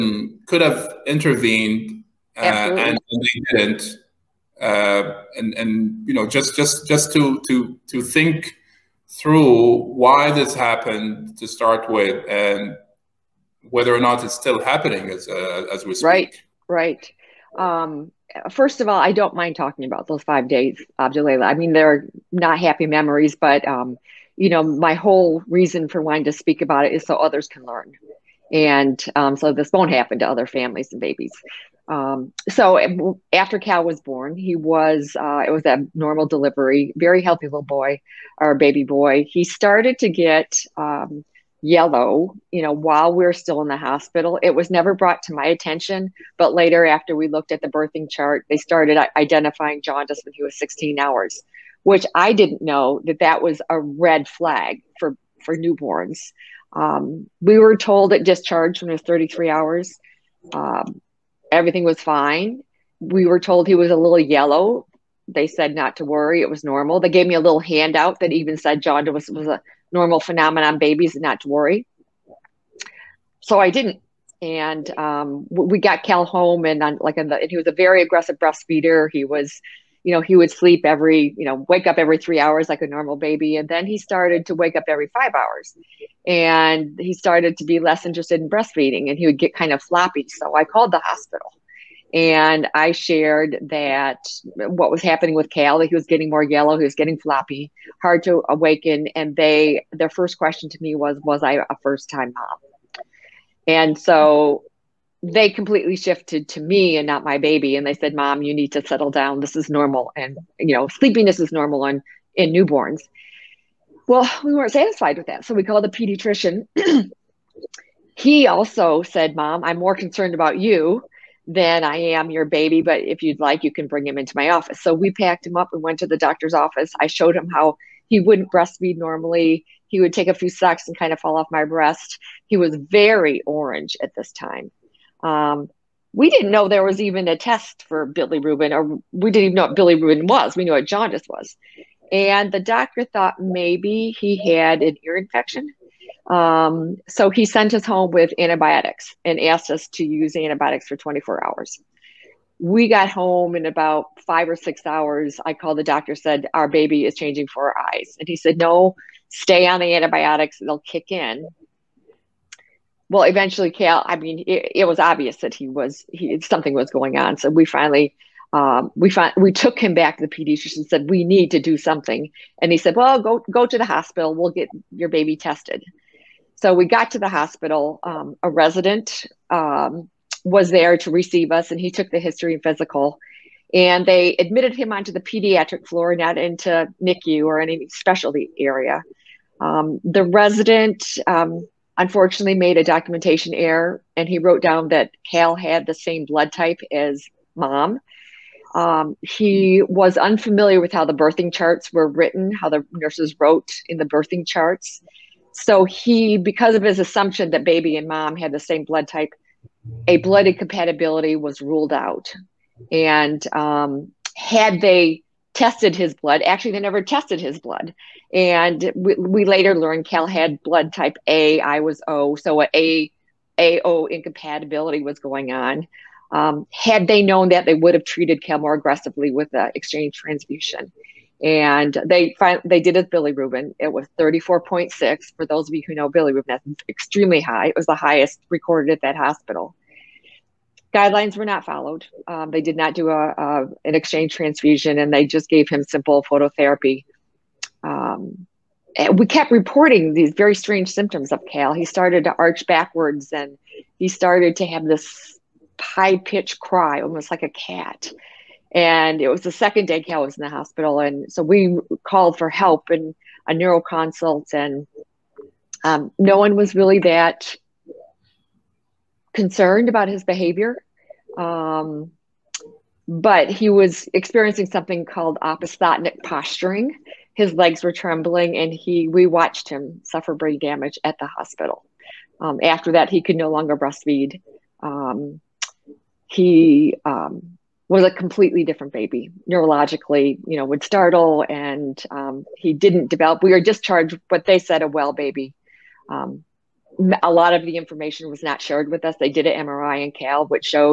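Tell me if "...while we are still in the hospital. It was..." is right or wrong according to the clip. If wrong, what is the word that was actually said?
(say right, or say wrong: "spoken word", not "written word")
right.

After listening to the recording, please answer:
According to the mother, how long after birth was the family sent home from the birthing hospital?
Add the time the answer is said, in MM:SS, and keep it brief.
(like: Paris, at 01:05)
33 hours, at 00:59.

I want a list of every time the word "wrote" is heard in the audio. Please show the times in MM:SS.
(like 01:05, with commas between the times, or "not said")
03:14, 03:23.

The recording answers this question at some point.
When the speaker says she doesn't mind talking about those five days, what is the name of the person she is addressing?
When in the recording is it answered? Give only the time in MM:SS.
00:20.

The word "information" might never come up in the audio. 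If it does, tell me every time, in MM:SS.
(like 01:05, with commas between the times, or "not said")
04:57.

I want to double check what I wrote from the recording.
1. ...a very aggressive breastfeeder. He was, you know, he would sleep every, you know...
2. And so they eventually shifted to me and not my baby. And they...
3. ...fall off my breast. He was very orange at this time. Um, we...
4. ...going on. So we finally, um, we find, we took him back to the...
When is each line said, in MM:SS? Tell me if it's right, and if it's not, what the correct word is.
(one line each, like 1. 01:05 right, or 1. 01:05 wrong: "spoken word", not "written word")
1. 01:17 right
2. 01:43 wrong: "completely", not "eventually"
3. 02:11 right
4. 02:46 right.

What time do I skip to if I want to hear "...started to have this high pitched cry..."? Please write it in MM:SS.
04:14.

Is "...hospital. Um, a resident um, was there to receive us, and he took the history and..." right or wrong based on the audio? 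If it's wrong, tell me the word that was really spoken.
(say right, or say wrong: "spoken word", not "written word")
right.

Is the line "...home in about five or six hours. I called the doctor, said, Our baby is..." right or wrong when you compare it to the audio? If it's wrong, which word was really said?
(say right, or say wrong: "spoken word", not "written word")
right.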